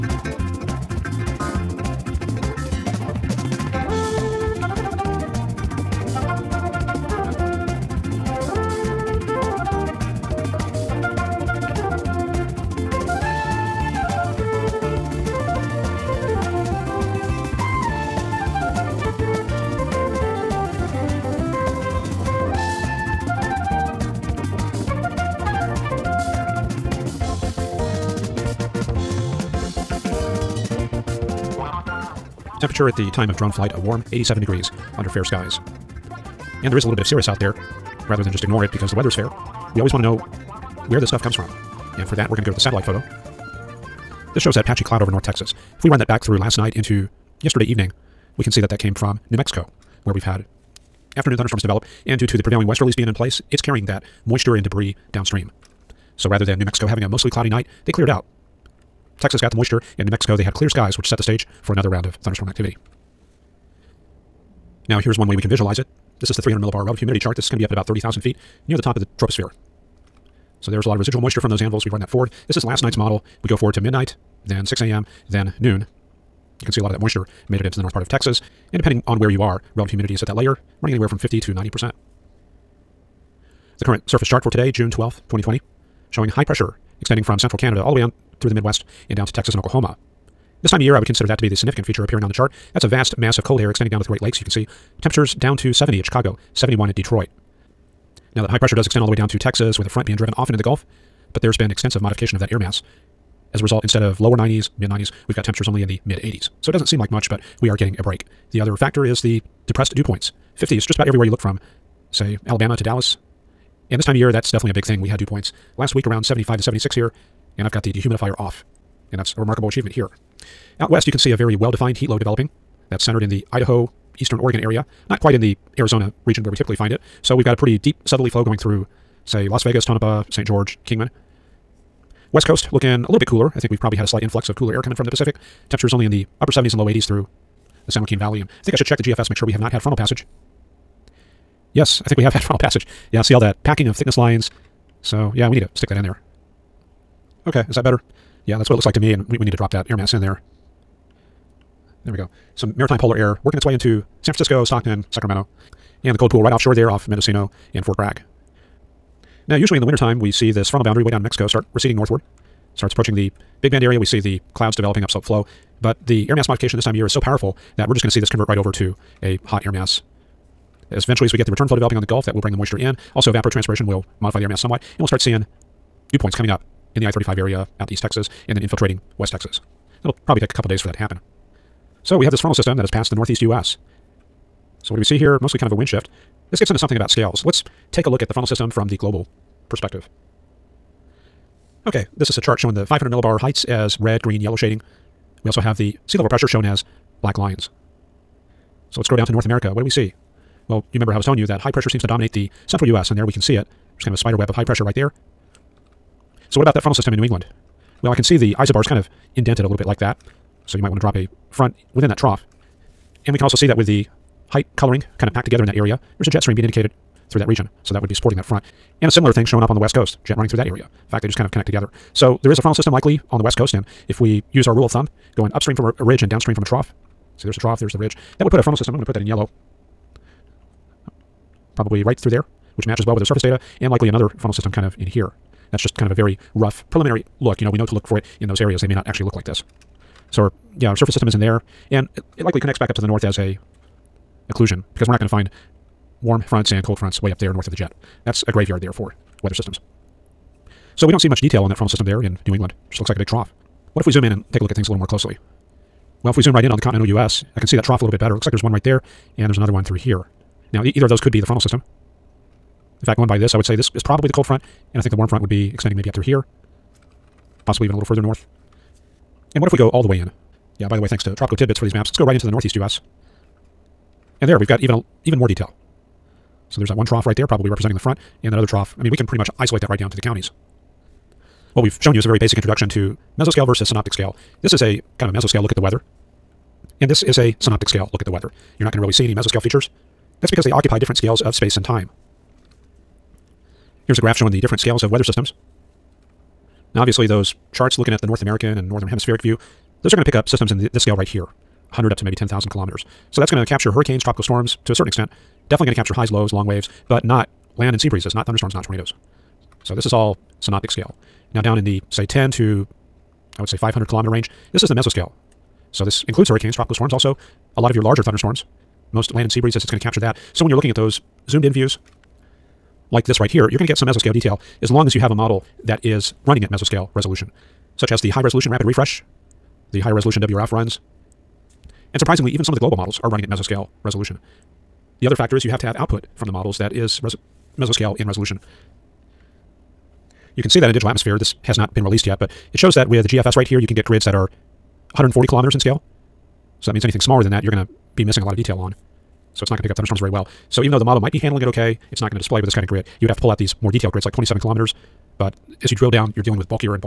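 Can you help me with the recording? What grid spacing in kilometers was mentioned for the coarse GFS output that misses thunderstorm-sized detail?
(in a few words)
140 kilometers.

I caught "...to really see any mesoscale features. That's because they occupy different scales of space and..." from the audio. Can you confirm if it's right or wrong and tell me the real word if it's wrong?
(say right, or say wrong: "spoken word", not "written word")
right.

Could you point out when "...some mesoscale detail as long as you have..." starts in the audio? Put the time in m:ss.
5:23.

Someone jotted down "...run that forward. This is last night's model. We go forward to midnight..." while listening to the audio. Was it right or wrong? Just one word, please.
right.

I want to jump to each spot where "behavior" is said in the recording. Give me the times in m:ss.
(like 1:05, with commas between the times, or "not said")
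not said.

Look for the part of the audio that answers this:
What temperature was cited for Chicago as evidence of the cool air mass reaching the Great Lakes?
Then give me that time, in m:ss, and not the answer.
1:35.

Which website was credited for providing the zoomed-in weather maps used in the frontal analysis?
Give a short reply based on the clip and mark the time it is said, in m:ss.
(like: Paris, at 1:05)
Tropical Tidbits, at 4:31.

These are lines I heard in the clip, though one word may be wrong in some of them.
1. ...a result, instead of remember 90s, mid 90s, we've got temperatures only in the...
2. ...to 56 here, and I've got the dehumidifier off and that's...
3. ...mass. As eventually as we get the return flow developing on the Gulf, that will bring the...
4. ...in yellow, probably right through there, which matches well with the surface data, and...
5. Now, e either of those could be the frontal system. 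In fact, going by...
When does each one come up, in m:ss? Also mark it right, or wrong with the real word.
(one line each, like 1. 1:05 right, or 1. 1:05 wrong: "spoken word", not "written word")
1. 1:43 wrong: "lower", not "remember"
2. 1:56 wrong: "76", not "56"
3. 2:49 right
4. 3:49 right
5. 4:20 right.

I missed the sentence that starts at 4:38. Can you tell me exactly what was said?
I mean, we can pretty much isolate that right down to the counties.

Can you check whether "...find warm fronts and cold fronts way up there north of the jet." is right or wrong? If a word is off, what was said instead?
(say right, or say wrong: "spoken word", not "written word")
right.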